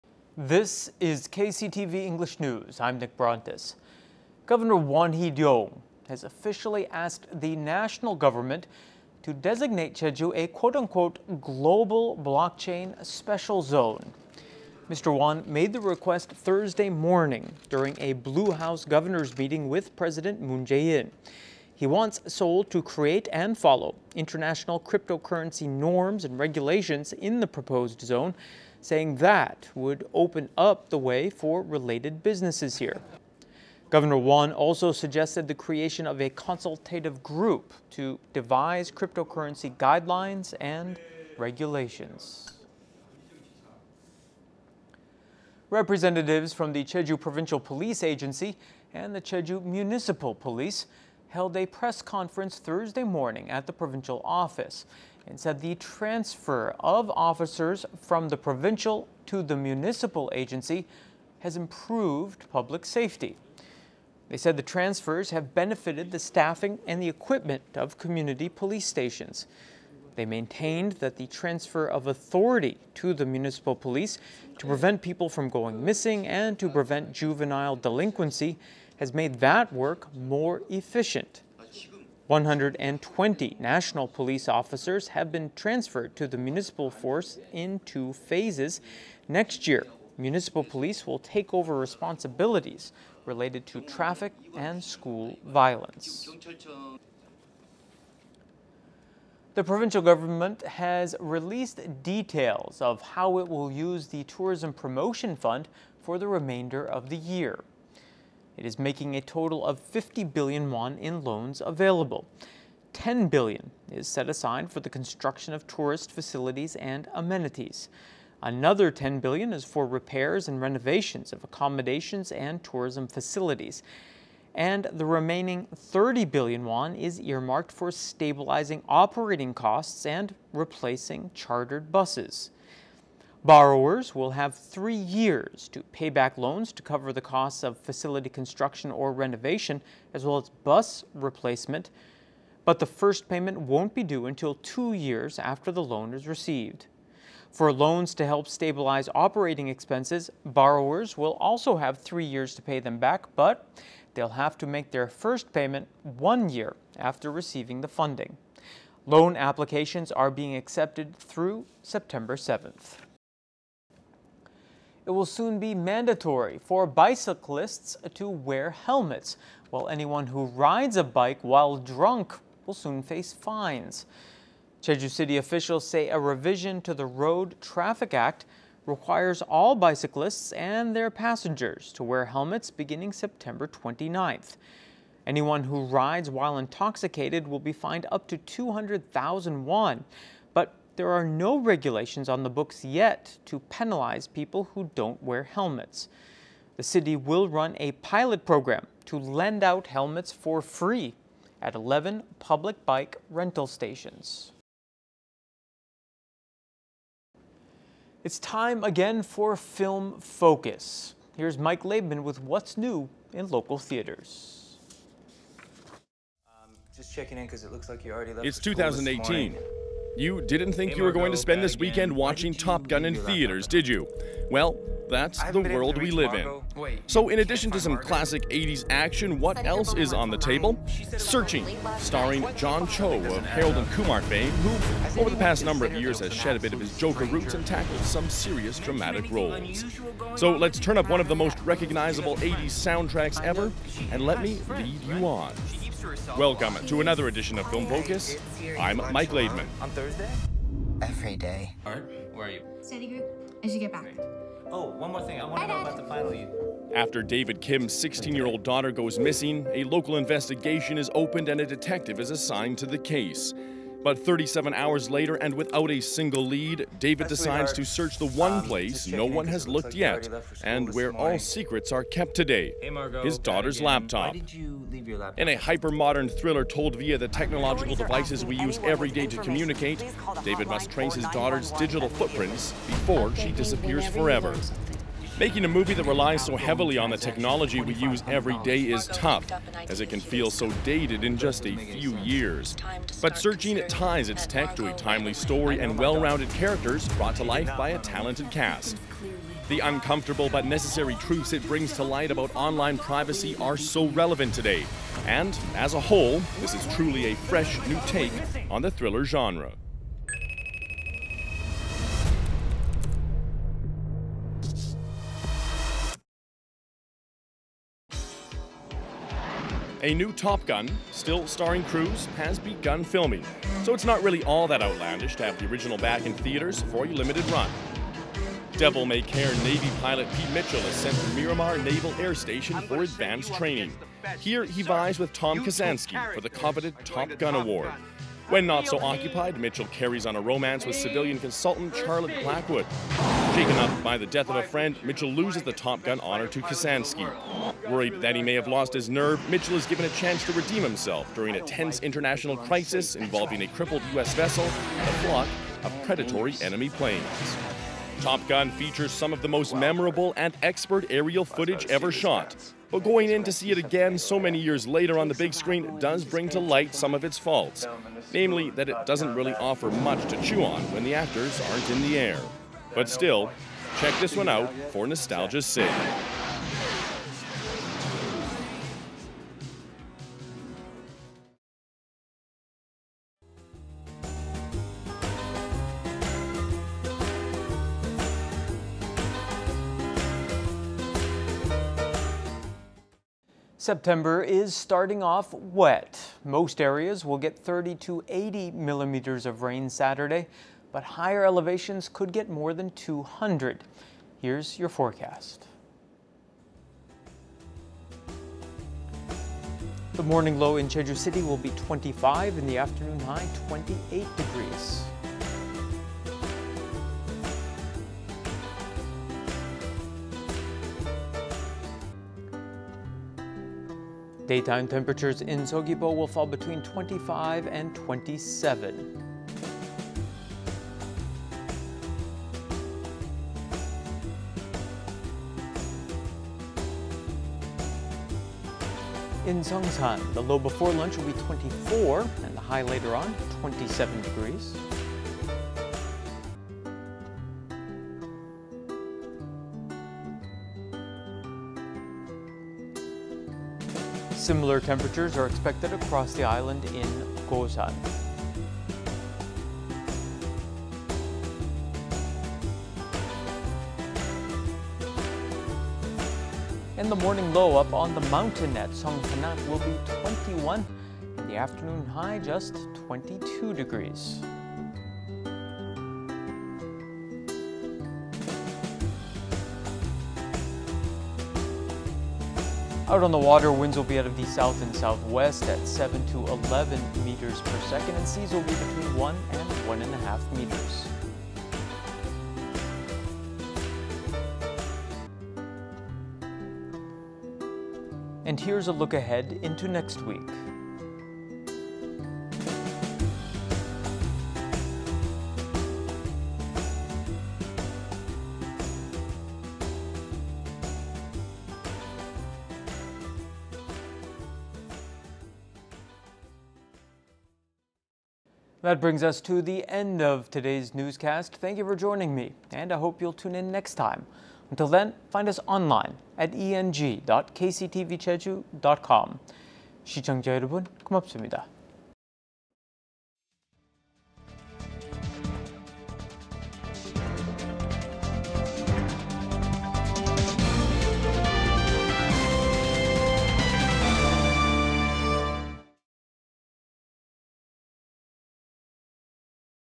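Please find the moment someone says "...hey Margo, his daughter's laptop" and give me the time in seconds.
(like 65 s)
272 s.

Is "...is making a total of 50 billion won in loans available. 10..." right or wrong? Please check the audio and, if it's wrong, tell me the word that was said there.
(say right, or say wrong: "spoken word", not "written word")
right.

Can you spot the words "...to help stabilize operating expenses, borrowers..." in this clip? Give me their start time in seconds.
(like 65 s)
148 s.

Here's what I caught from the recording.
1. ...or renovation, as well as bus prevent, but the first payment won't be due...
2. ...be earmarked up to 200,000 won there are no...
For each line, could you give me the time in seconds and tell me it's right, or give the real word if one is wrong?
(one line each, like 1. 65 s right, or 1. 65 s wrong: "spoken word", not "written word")
1. 138 s wrong: "replacement", not "prevent"
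2. 187 s wrong: "fined", not "earmarked".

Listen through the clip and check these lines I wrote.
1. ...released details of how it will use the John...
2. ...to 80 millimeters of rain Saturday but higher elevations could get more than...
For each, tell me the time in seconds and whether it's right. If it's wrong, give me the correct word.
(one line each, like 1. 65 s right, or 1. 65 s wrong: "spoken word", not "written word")
1. 101 s wrong: "Tourism", not "John"
2. 397 s right.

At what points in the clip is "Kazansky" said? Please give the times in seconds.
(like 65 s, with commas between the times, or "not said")
335 s, 346 s.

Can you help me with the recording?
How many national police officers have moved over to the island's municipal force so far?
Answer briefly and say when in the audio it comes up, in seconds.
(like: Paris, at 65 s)
120, at 82 s.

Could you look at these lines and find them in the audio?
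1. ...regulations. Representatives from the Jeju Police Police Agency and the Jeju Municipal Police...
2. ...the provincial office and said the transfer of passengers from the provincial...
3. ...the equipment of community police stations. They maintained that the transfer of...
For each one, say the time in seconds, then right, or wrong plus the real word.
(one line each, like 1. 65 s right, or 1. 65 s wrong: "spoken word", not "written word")
1. 41 s wrong: "Provincial", not "Police"
2. 53 s wrong: "officers", not "passengers"
3. 67 s right.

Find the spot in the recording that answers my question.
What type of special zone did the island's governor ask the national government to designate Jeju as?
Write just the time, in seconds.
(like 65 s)
11 s.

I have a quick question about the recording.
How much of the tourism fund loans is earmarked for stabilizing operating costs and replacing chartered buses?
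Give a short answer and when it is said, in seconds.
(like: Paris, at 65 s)
30 billion won, at 125 s.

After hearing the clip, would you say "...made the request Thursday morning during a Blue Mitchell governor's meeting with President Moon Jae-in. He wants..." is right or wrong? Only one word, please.
wrong.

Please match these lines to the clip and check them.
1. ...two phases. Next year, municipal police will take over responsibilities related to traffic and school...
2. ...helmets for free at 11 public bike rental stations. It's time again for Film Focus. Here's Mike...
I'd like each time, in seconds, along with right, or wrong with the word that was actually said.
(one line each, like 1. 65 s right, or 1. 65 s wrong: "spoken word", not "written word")
1. 87 s right
2. 199 s right.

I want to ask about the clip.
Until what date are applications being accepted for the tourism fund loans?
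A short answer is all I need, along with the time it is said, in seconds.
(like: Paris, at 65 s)
September 7, at 161 s.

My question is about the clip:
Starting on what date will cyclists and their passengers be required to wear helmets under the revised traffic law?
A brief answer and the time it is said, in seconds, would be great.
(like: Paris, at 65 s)
September 29, at 183 s.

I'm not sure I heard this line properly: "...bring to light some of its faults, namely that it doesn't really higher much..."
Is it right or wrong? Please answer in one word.
wrong.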